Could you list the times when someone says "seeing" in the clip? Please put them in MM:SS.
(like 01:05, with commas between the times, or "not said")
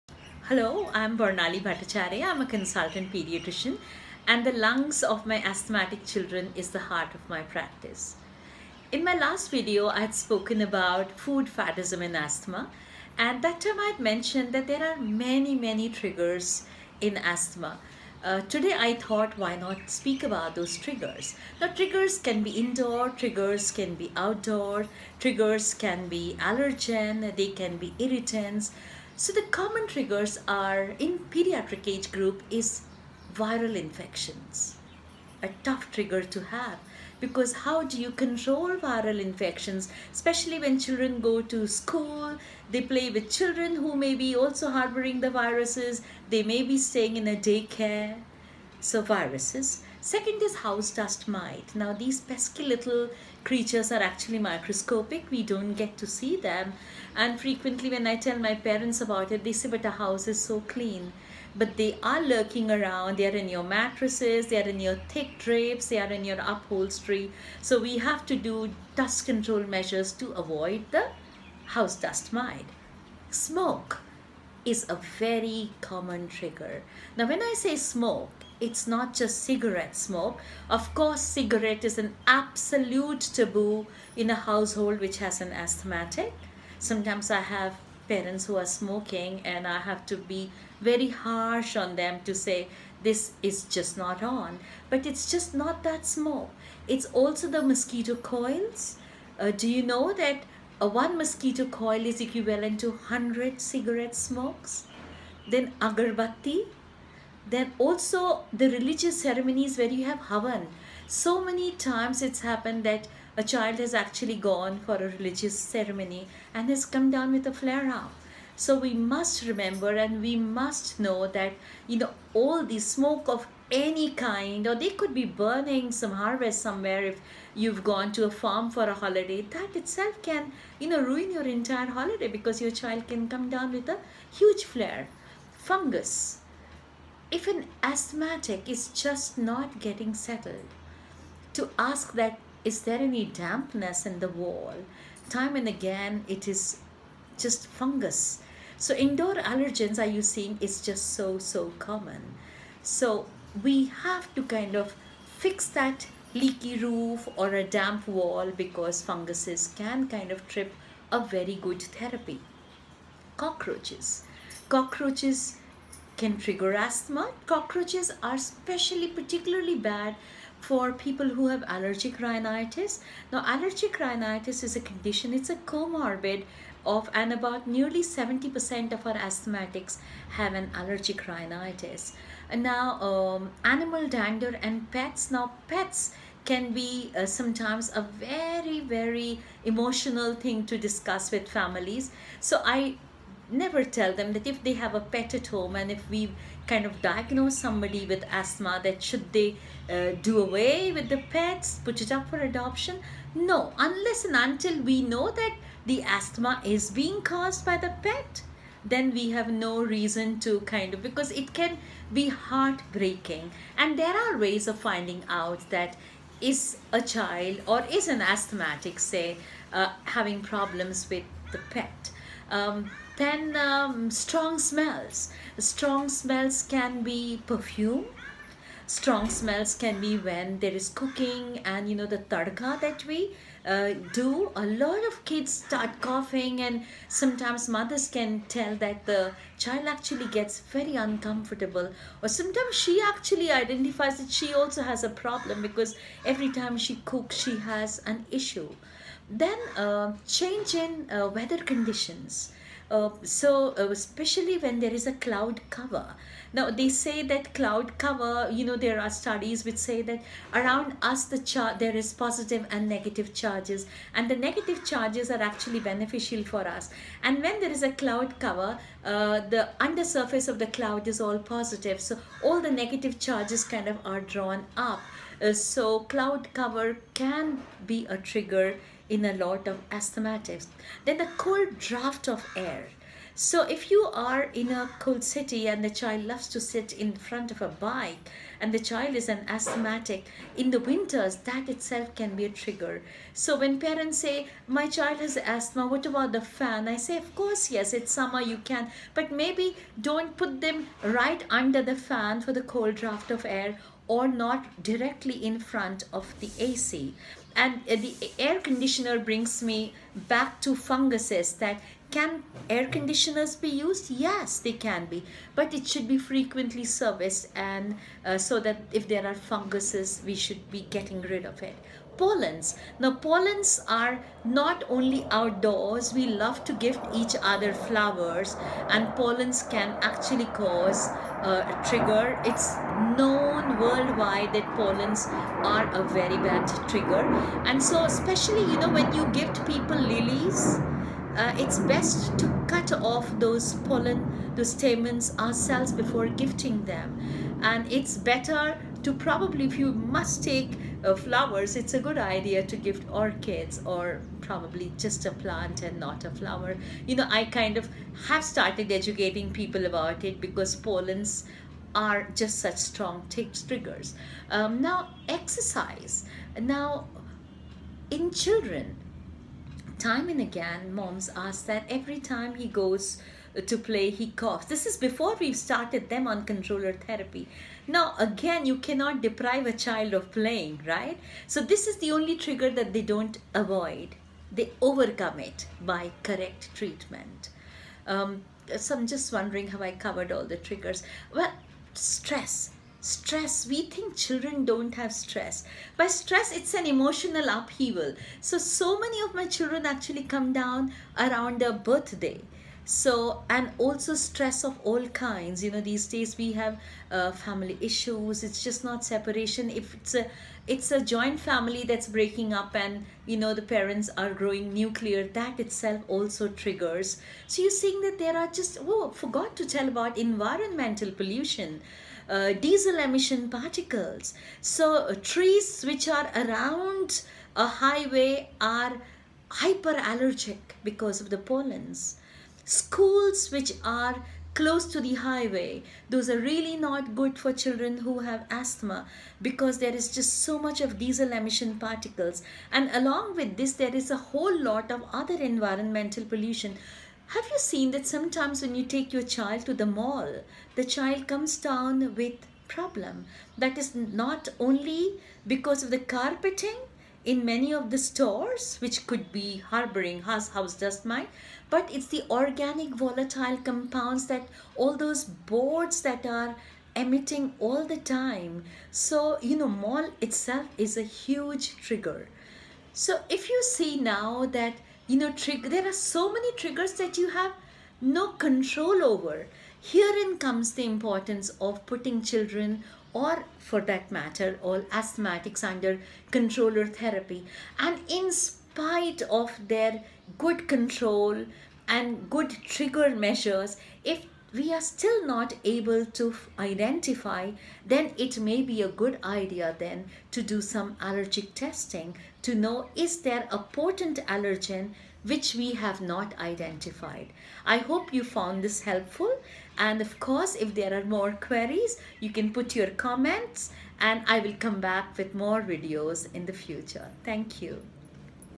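02:30, 06:57.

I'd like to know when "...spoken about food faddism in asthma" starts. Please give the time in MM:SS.
00:10.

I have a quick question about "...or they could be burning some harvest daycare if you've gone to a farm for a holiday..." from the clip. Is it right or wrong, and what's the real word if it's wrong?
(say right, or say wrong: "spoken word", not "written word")
wrong: "somewhere", not "daycare".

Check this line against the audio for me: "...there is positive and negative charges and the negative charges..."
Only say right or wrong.
right.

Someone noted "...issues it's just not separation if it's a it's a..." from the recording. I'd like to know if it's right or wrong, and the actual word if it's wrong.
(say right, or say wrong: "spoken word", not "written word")
right.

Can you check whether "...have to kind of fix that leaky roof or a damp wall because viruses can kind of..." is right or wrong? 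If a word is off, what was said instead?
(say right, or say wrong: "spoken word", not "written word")
wrong: "funguses", not "viruses".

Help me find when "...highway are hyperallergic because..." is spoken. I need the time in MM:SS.
07:07.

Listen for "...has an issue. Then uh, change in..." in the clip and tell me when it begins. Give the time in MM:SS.
04:07.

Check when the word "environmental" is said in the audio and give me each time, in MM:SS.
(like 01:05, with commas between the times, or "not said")
07:00, 07:25.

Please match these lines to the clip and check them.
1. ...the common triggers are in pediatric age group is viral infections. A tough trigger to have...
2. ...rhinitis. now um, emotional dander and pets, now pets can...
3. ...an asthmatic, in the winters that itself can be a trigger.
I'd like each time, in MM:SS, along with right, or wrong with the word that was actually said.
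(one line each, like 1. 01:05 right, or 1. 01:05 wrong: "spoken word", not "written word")
1. 00:29 right
2. 03:01 wrong: "animal", not "emotional"
3. 04:49 right.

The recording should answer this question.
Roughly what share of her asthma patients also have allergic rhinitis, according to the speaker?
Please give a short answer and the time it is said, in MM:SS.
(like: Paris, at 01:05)
70%, at 02:58.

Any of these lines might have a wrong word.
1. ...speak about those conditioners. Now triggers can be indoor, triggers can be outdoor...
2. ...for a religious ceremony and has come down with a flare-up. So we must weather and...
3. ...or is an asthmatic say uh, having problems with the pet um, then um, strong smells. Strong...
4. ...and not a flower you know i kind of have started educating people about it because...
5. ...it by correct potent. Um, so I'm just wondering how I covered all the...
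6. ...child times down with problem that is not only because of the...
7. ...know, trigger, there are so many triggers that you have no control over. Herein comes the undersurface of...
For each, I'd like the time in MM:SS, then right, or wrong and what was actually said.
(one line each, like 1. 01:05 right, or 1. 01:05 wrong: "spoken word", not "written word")
1. 00:19 wrong: "triggers", not "conditioners"
2. 01:54 wrong: "remember", not "weather"
3. 03:37 right
4. 05:55 right
5. 06:25 wrong: "treatment", not "potent"
6. 07:30 wrong: "comes", not "times"
7. 07:55 wrong: "importance", not "undersurface".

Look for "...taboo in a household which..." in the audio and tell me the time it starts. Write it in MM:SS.
01:23.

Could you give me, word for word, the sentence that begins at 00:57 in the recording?
And frequently when I tell my parents about it, they say, but the house is so clean.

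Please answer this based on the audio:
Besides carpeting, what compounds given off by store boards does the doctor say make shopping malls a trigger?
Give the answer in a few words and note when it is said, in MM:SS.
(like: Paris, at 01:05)
Organic volatile compounds, at 07:42.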